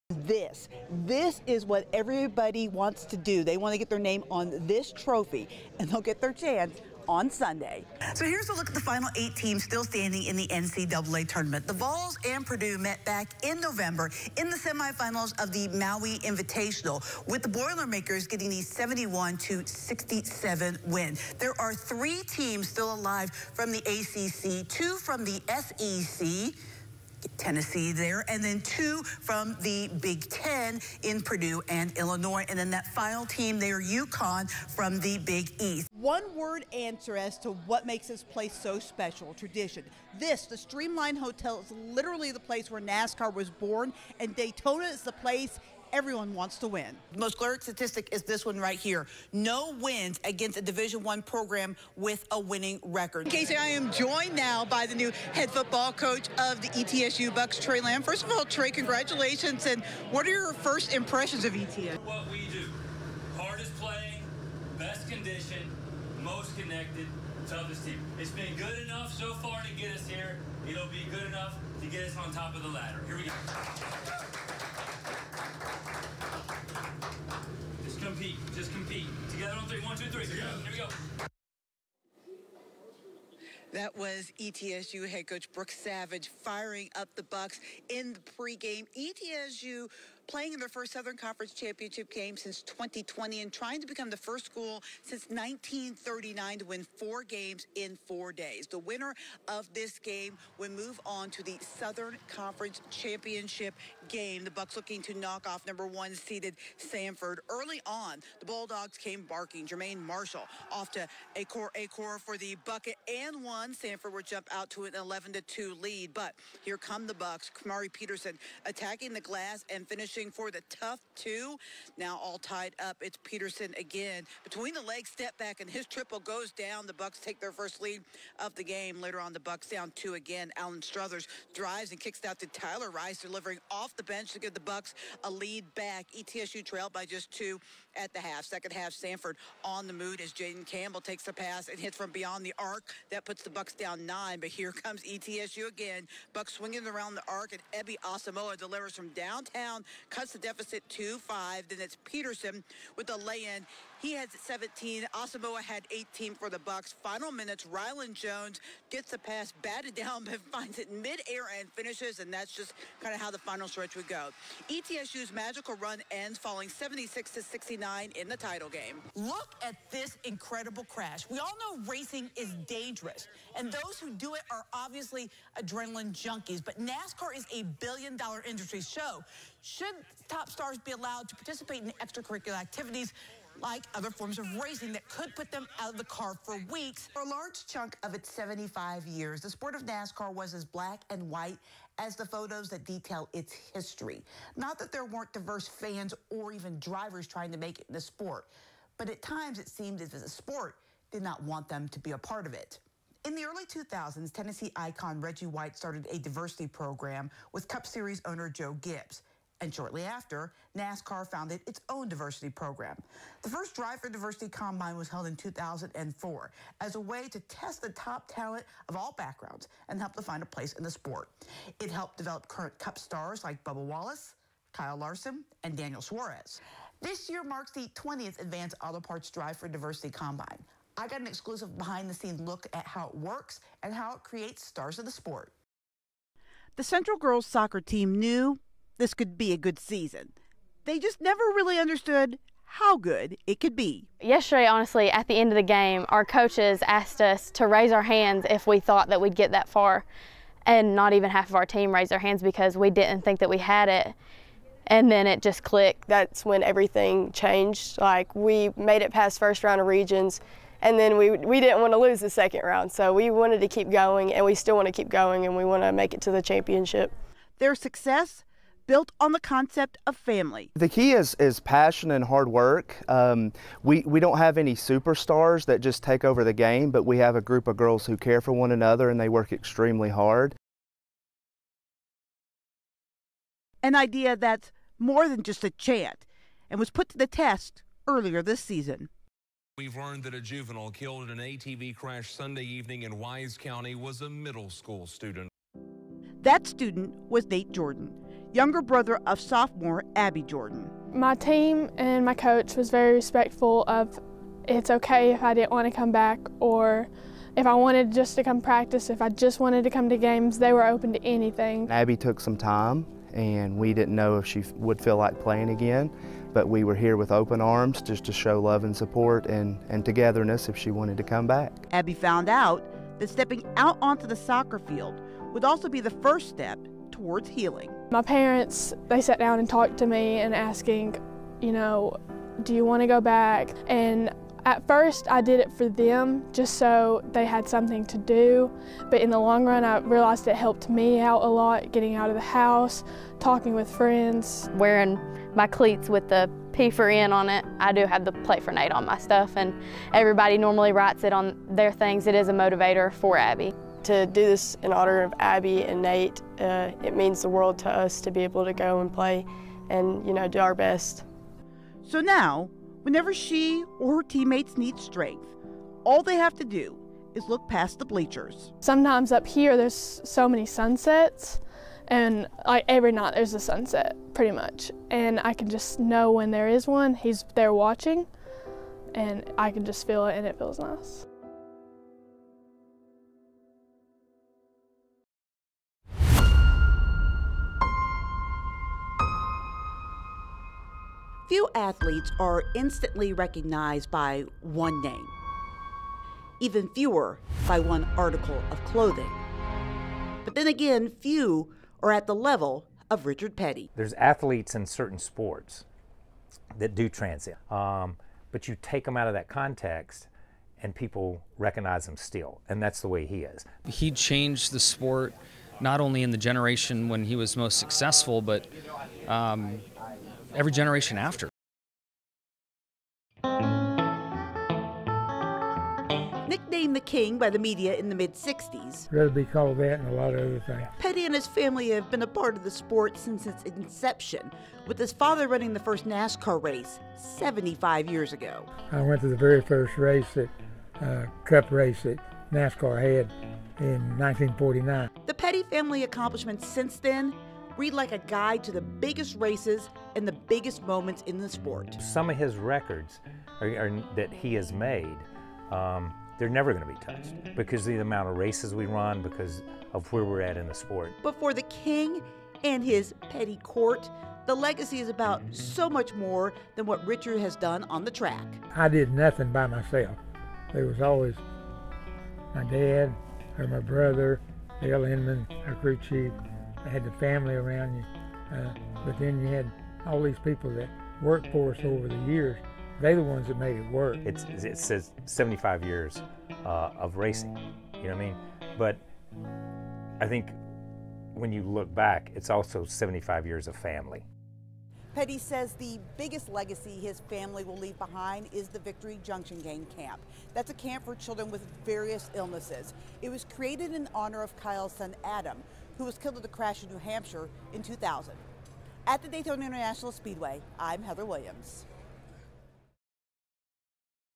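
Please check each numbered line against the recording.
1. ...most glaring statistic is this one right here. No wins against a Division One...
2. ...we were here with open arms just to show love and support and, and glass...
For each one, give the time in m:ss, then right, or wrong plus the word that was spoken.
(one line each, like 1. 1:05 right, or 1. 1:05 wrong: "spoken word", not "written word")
1. 0:47 right
2. 5:16 wrong: "togetherness", not "glass".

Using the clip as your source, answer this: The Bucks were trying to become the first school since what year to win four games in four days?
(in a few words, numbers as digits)
1939.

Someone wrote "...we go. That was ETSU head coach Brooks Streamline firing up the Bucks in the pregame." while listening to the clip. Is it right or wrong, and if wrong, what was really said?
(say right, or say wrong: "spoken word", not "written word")
wrong: "Savage", not "Streamline".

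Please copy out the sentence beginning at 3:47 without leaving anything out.
This year marks the 20th Advanced Auto Parts Drive for Diversity Combine.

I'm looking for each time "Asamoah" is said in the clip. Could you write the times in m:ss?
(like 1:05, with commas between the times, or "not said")
2:28, 2:35.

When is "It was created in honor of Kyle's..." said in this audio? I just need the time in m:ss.
8:23.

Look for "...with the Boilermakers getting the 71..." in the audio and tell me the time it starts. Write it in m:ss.
0:17.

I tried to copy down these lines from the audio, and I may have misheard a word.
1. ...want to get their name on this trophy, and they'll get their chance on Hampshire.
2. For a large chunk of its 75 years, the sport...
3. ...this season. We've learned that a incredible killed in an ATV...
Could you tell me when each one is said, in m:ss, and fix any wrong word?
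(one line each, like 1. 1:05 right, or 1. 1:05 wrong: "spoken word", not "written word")
1. 0:03 wrong: "Sunday", not "Hampshire"
2. 3:07 right
3. 4:48 wrong: "juvenile", not "incredible".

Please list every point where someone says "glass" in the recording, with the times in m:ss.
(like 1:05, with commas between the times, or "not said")
1:59.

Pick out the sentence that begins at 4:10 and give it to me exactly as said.
And not even half of our team raised their hands because we didn't think that we had it.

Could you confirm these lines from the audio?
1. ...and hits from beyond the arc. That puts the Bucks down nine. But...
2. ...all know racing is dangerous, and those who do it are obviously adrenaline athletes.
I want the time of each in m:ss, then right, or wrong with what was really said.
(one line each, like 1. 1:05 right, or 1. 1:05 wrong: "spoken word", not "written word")
1. 2:21 right
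2. 2:51 wrong: "junkies", not "athletes".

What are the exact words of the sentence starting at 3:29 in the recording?
And shortly after, NASCAR founded its own diversity program.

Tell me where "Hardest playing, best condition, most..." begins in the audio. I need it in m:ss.
1:03.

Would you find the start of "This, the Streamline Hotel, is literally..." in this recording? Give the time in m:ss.
0:40.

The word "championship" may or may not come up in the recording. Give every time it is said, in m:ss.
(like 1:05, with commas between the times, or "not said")
1:31, 1:42, 4:26.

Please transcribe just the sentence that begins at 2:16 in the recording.
ETSU trailed by just two at the half.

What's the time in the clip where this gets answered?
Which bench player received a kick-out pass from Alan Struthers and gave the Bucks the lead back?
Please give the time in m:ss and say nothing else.
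2:12.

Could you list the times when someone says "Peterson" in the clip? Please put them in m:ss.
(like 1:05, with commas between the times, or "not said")
1:57, 2:03, 2:32.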